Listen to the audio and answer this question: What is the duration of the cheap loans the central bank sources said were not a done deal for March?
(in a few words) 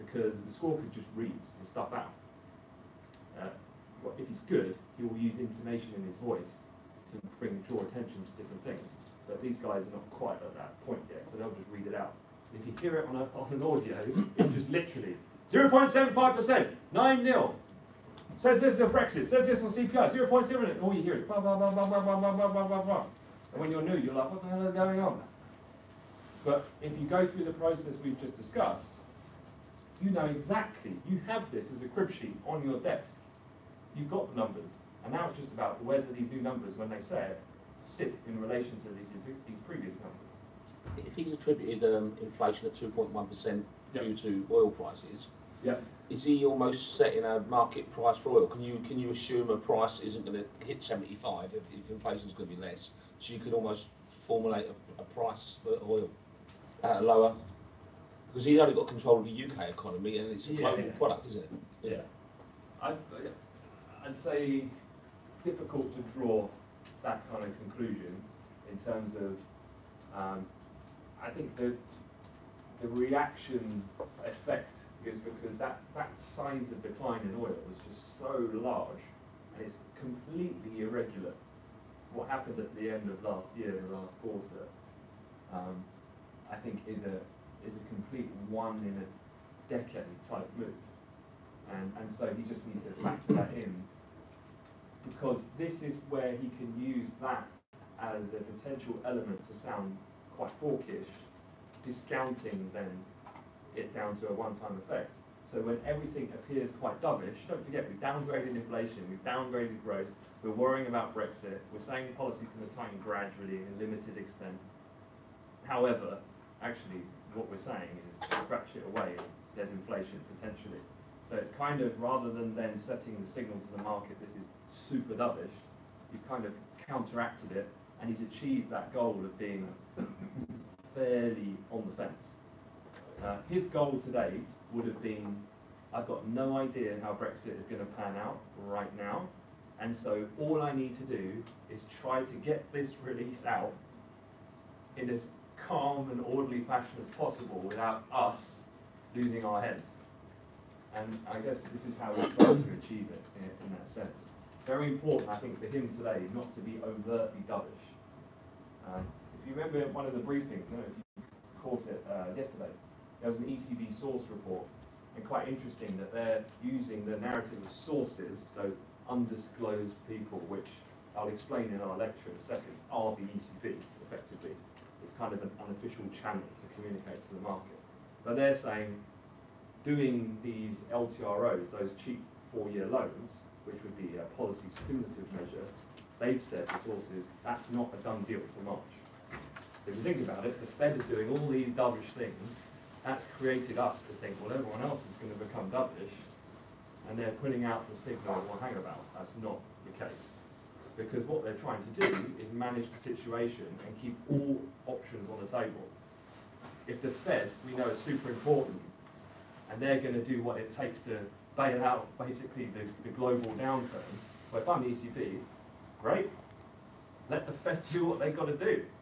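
4 years.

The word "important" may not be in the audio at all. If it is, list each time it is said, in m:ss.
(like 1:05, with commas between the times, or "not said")
2:34, 3:28.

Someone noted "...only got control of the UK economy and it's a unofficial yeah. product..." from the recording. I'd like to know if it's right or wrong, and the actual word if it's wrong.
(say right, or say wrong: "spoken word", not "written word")
wrong: "global", not "unofficial".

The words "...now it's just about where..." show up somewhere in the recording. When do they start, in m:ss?
0:35.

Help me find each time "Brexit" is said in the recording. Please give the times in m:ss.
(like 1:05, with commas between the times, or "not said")
0:18, 1:51, 2:17.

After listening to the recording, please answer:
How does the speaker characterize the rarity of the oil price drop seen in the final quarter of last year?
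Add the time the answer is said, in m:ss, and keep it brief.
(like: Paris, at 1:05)
one in a decade, at 1:28.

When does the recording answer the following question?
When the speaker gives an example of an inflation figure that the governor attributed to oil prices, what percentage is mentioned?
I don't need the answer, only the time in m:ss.
0:42.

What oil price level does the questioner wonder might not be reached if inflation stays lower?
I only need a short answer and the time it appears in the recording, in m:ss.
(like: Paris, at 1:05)
75, at 0:50.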